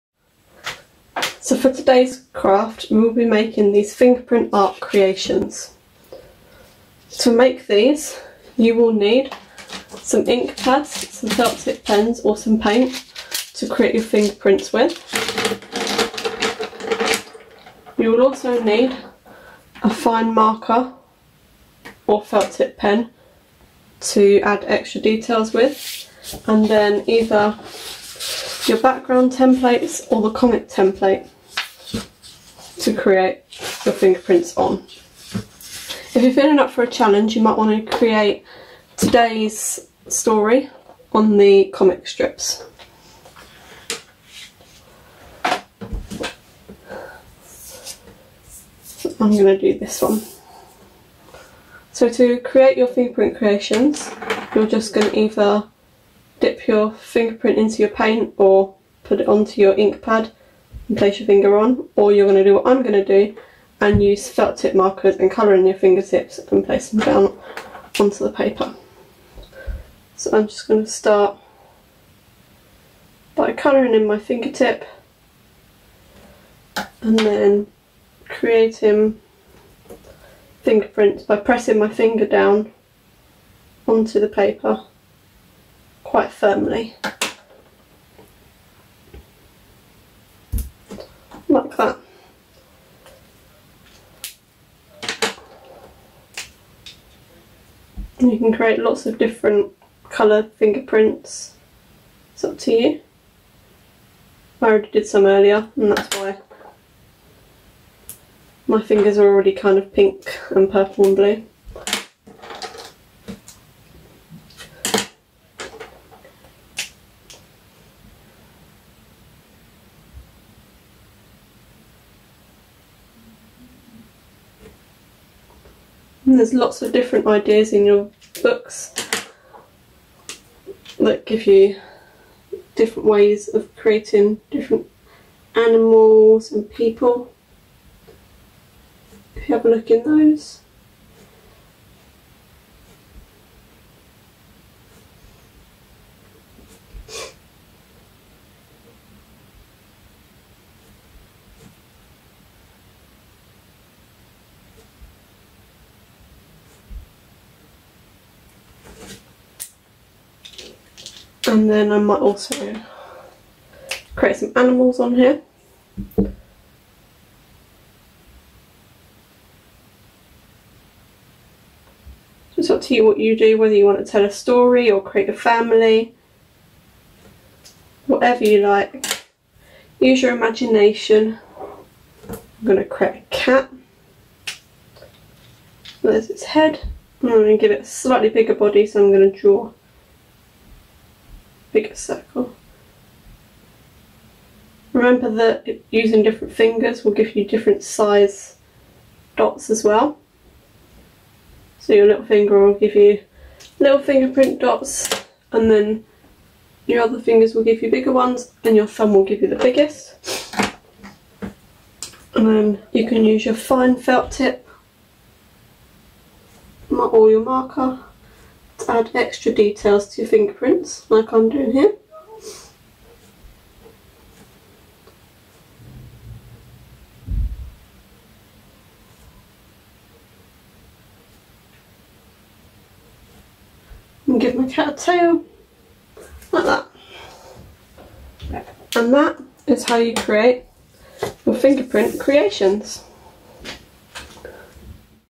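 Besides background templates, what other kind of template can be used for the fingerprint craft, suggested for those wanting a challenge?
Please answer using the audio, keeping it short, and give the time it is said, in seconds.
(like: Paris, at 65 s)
comic template, at 30 s.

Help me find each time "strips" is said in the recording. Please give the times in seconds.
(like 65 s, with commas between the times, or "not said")
42 s.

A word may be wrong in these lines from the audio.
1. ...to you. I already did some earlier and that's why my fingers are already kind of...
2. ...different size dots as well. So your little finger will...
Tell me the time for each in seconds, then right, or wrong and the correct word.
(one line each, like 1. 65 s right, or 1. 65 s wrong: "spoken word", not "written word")
1. 102 s right
2. 197 s right.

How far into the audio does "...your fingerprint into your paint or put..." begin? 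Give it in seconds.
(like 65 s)
56 s.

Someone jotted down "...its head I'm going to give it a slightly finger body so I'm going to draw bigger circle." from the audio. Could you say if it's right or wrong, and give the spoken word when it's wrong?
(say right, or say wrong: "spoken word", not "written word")
wrong: "bigger", not "finger".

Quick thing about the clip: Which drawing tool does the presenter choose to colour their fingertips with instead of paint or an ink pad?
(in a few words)
felt tip markers.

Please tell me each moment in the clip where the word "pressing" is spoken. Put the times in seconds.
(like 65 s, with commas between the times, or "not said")
81 s.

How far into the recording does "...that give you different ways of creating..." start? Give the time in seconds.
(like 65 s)
130 s.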